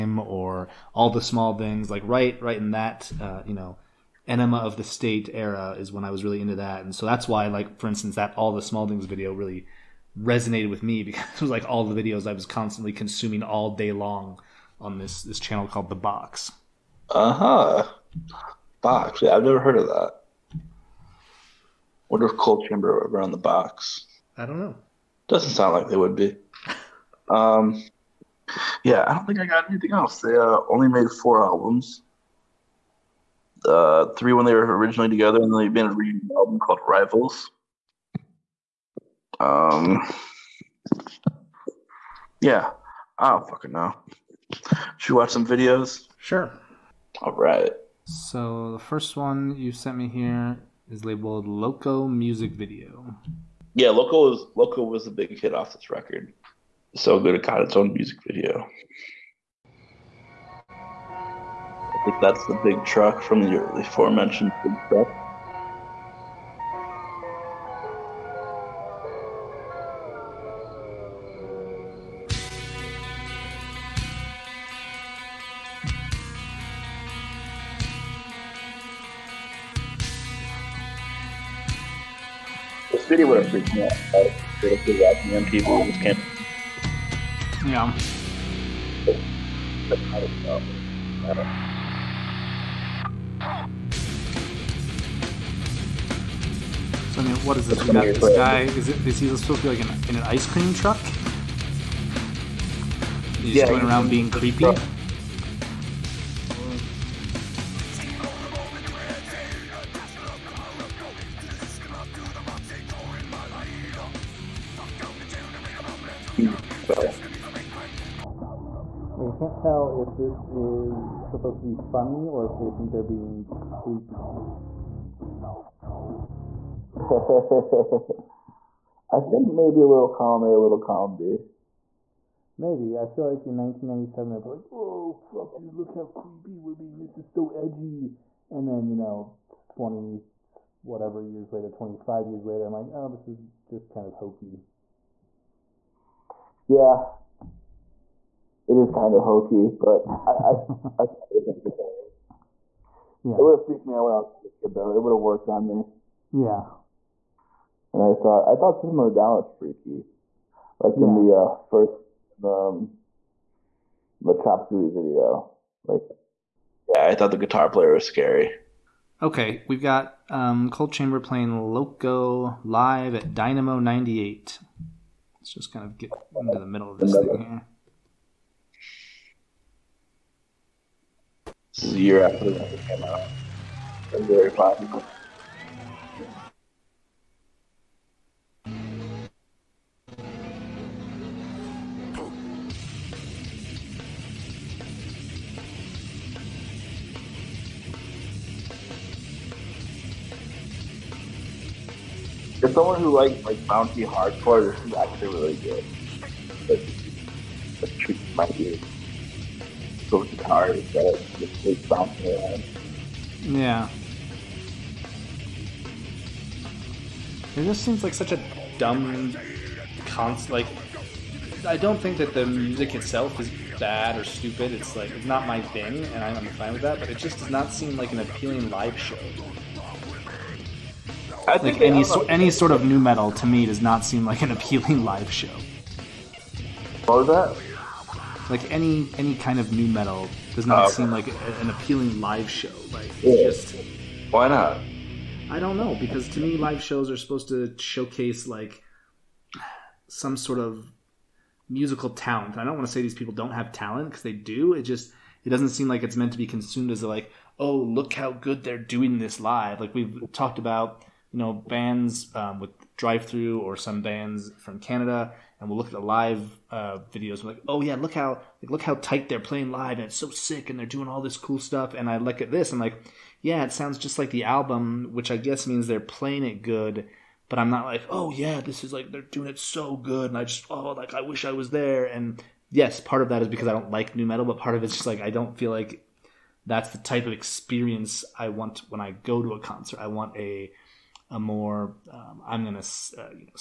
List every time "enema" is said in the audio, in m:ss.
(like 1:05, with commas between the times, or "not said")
0:04.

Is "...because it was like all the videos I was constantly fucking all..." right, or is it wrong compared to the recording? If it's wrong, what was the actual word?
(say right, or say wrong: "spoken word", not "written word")
wrong: "consuming", not "fucking".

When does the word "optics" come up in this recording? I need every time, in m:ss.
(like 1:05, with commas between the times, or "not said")
not said.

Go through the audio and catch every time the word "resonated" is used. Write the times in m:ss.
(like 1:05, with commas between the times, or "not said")
0:10.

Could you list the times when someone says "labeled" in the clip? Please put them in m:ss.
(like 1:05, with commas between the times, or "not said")
0:51.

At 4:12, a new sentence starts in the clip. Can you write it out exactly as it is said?
I don't want to say these people don't have talent because they do.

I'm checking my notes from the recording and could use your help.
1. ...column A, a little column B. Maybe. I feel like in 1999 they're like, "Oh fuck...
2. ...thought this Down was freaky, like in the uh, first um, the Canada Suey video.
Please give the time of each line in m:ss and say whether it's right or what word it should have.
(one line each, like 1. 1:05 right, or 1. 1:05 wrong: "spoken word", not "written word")
1. 2:10 wrong: "1997", not "1999"
2. 2:38 wrong: "Chop", not "Canada".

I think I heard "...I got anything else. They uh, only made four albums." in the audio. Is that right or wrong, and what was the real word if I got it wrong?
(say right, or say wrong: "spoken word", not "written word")
right.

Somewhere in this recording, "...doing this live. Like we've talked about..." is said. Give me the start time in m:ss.
4:18.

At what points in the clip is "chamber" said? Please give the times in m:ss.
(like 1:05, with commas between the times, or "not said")
0:22, 2:50.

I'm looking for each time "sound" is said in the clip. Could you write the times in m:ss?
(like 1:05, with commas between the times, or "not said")
0:25, 4:33.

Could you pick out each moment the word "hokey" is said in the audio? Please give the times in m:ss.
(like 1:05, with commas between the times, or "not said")
2:24, 2:29.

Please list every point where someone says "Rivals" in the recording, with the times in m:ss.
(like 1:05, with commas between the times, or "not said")
0:36.